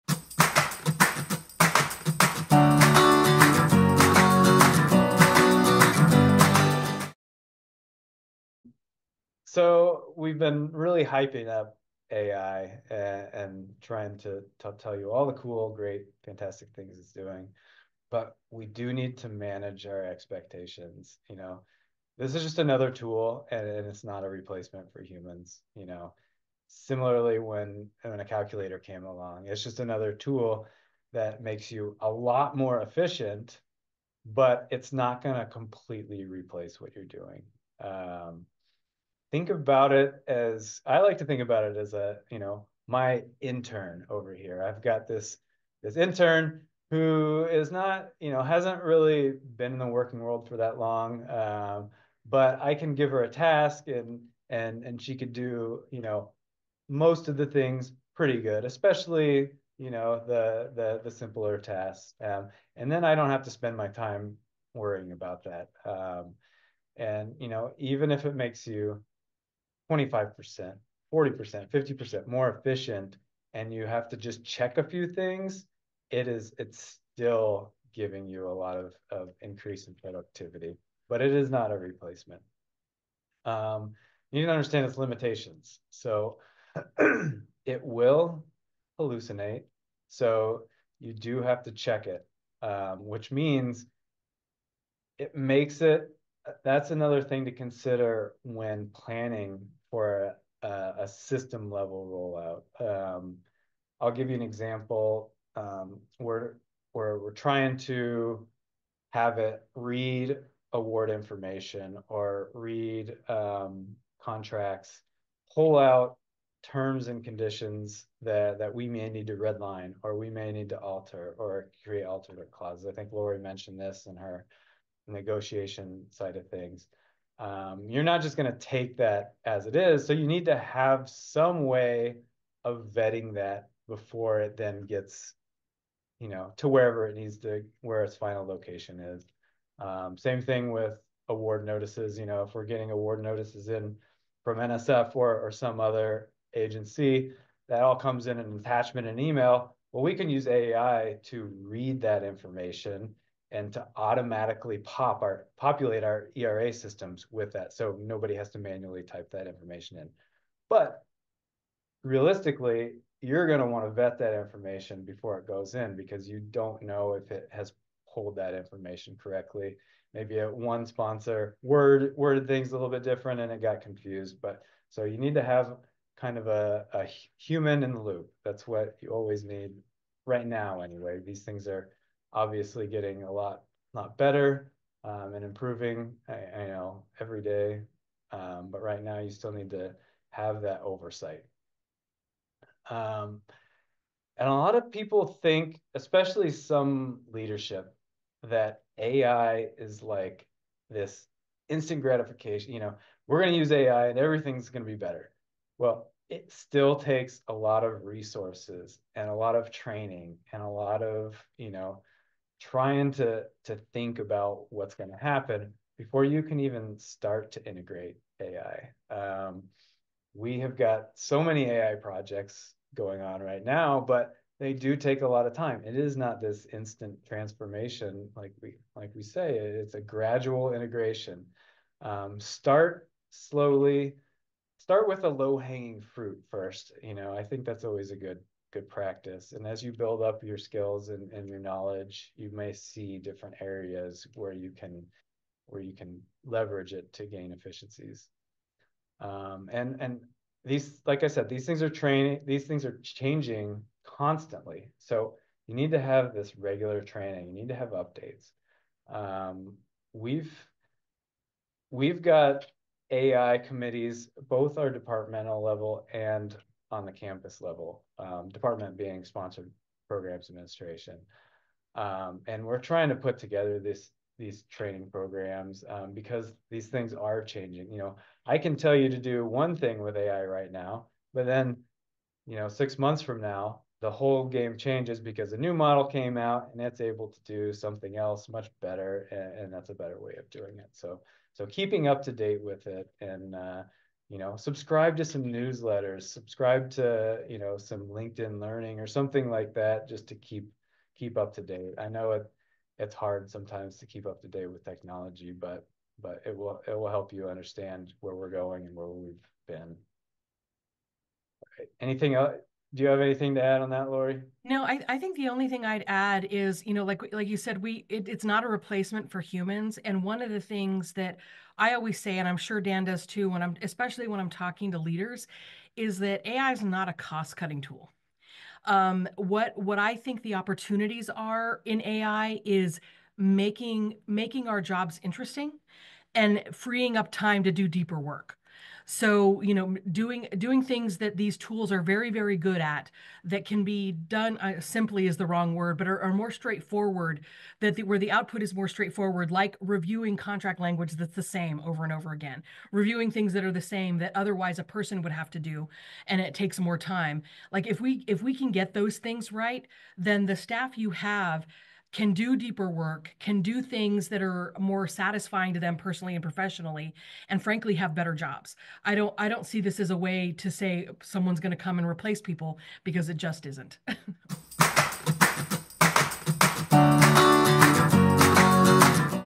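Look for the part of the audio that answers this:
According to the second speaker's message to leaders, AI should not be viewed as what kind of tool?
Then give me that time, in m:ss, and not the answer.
5:27.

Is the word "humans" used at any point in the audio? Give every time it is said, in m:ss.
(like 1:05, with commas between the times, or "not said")
0:25, 2:57, 5:19.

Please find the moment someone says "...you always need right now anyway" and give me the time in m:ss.
2:59.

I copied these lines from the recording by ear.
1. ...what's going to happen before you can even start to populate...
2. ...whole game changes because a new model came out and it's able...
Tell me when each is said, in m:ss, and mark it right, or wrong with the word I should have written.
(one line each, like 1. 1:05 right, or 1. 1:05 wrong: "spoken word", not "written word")
1. 3:34 wrong: "integrate", not "populate"
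2. 4:44 right.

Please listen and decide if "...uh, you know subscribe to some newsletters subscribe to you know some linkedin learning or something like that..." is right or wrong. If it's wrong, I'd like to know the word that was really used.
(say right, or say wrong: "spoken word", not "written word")
right.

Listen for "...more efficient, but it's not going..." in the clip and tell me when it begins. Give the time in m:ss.
0:32.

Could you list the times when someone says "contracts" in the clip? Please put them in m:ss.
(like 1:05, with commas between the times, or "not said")
1:54, 5:50.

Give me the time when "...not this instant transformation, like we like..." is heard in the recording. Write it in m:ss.
3:46.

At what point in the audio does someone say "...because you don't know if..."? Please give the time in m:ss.
2:45.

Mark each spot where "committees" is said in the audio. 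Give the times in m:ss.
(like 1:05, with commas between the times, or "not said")
4:23.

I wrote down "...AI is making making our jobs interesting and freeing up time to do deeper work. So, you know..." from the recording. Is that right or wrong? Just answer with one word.
right.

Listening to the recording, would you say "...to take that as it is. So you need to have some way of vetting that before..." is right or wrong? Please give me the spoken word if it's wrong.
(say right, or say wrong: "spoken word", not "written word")
right.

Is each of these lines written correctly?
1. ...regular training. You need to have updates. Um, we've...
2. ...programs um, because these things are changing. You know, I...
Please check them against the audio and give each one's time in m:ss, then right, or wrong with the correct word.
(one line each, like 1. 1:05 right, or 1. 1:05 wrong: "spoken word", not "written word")
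1. 4:16 right
2. 4:35 right.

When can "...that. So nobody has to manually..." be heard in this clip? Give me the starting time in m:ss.
2:37.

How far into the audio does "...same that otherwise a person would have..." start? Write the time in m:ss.
5:53.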